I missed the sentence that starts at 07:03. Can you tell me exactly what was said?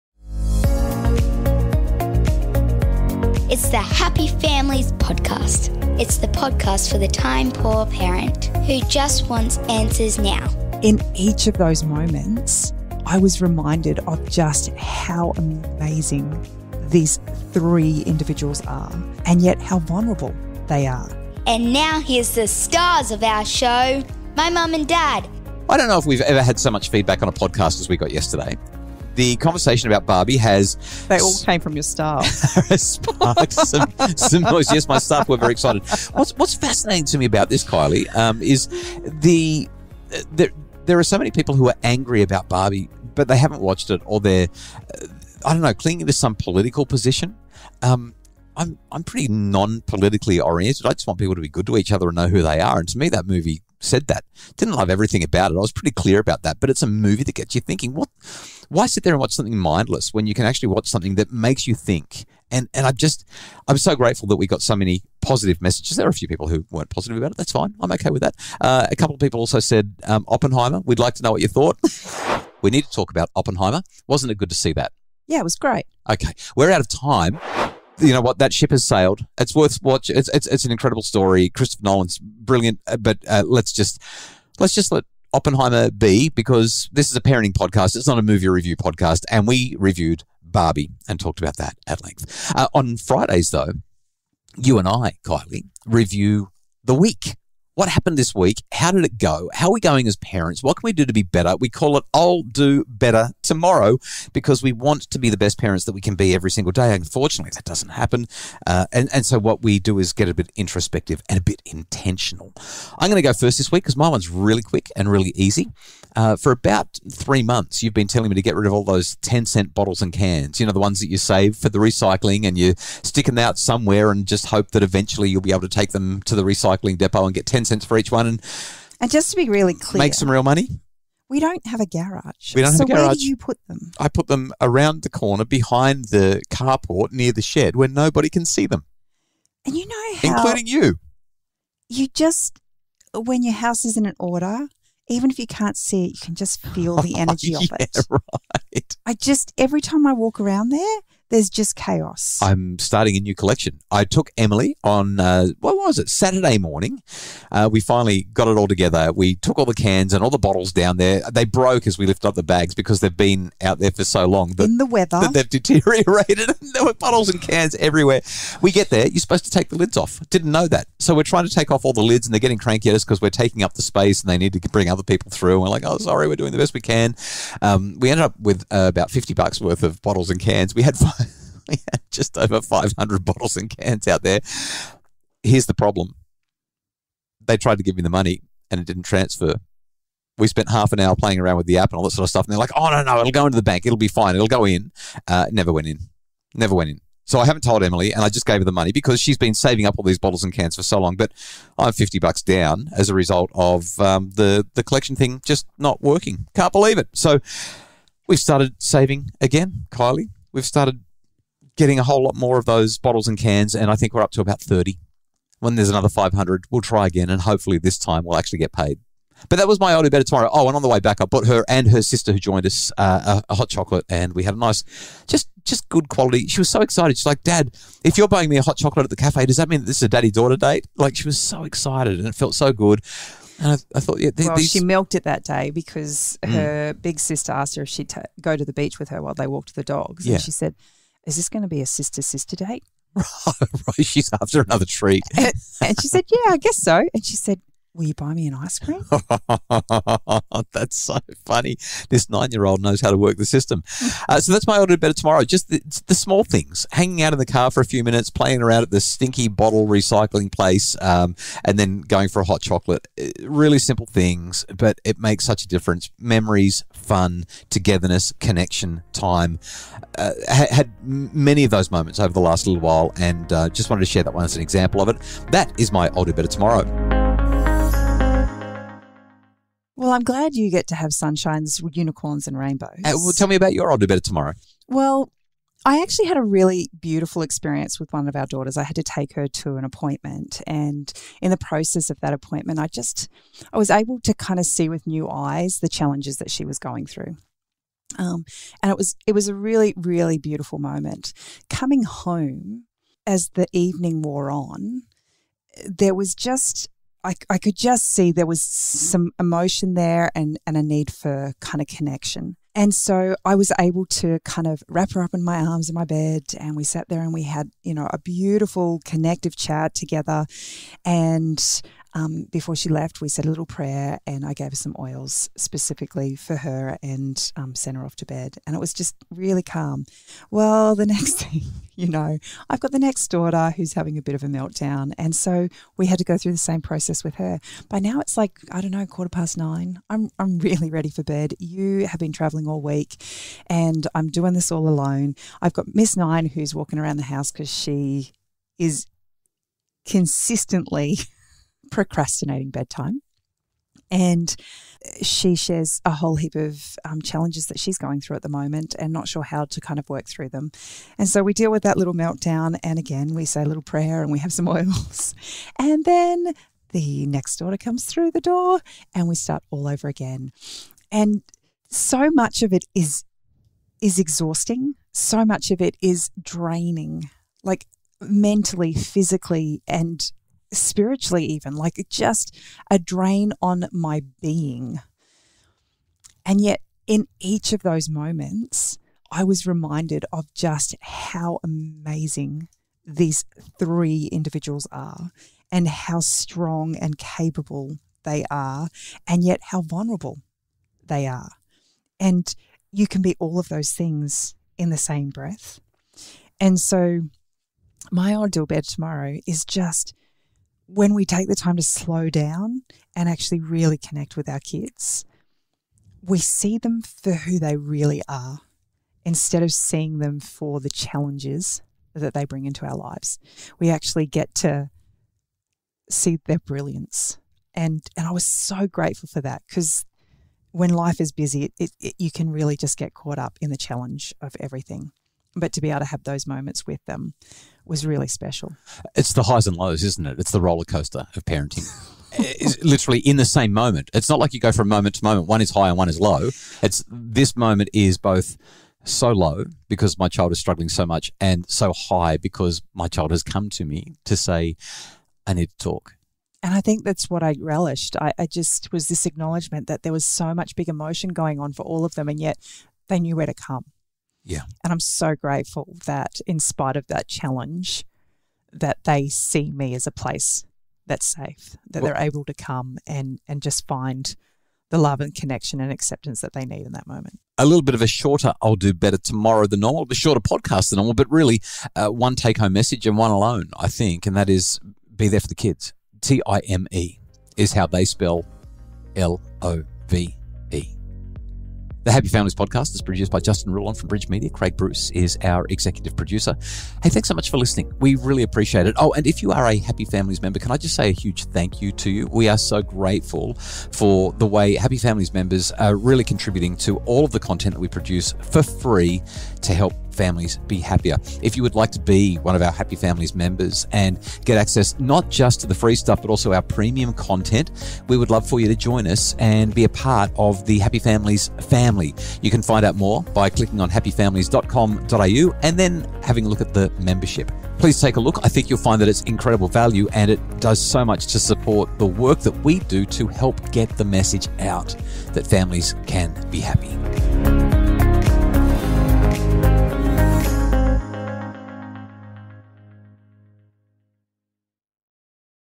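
We actually get to see their brilliance.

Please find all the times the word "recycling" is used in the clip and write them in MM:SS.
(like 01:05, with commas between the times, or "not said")
02:01, 02:06, 04:19.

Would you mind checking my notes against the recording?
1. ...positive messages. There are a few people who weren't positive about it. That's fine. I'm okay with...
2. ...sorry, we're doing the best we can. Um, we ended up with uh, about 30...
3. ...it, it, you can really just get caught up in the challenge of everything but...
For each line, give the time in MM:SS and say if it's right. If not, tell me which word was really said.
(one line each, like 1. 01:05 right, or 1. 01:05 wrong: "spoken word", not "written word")
1. 01:05 right
2. 02:55 wrong: "50", not "30"
3. 07:11 right.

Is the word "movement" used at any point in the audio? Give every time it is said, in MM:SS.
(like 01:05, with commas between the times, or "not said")
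not said.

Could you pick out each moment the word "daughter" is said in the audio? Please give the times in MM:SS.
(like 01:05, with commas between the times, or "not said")
03:50, 04:48, 05:33, 06:07.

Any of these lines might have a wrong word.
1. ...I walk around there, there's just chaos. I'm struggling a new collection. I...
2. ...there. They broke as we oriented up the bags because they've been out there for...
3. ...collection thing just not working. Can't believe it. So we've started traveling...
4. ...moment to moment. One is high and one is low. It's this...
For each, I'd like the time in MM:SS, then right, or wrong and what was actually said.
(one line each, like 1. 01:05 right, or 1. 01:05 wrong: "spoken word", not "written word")
1. 02:30 wrong: "starting", not "struggling"
2. 02:40 wrong: "lifted", not "oriented"
3. 03:24 wrong: "saving", not "traveling"
4. 07:24 right.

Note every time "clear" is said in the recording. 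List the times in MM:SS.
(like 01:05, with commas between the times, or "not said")
00:55, 02:09.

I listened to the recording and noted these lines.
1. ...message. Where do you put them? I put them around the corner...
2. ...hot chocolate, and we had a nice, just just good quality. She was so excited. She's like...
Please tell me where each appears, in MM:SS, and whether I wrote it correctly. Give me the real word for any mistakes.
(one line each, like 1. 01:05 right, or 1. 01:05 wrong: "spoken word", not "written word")
1. 02:12 wrong: "garage", not "message"
2. 03:43 right.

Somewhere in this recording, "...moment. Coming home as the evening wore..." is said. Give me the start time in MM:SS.
05:00.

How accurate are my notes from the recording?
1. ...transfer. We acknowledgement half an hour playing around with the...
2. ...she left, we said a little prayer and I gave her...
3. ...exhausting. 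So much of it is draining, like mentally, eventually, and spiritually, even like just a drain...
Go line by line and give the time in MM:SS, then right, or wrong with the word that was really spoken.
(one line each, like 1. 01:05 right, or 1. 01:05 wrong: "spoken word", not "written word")
1. 03:09 wrong: "spent", not "acknowledgement"
2. 05:22 right
3. 06:14 wrong: "physically", not "eventually".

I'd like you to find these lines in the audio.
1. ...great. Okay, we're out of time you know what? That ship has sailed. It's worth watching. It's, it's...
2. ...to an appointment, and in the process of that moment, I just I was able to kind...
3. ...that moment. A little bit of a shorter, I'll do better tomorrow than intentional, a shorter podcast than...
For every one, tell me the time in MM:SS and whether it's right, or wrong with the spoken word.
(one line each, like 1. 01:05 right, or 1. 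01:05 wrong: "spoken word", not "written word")
1. 01:15 right
2. 04:49 wrong: "appointment", not "moment"
3. 07:56 wrong: "normal", not "intentional".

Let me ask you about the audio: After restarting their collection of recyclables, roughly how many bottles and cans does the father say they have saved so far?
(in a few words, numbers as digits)
30.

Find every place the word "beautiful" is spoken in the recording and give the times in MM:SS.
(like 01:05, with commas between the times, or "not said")
04:46, 05:00, 05:18.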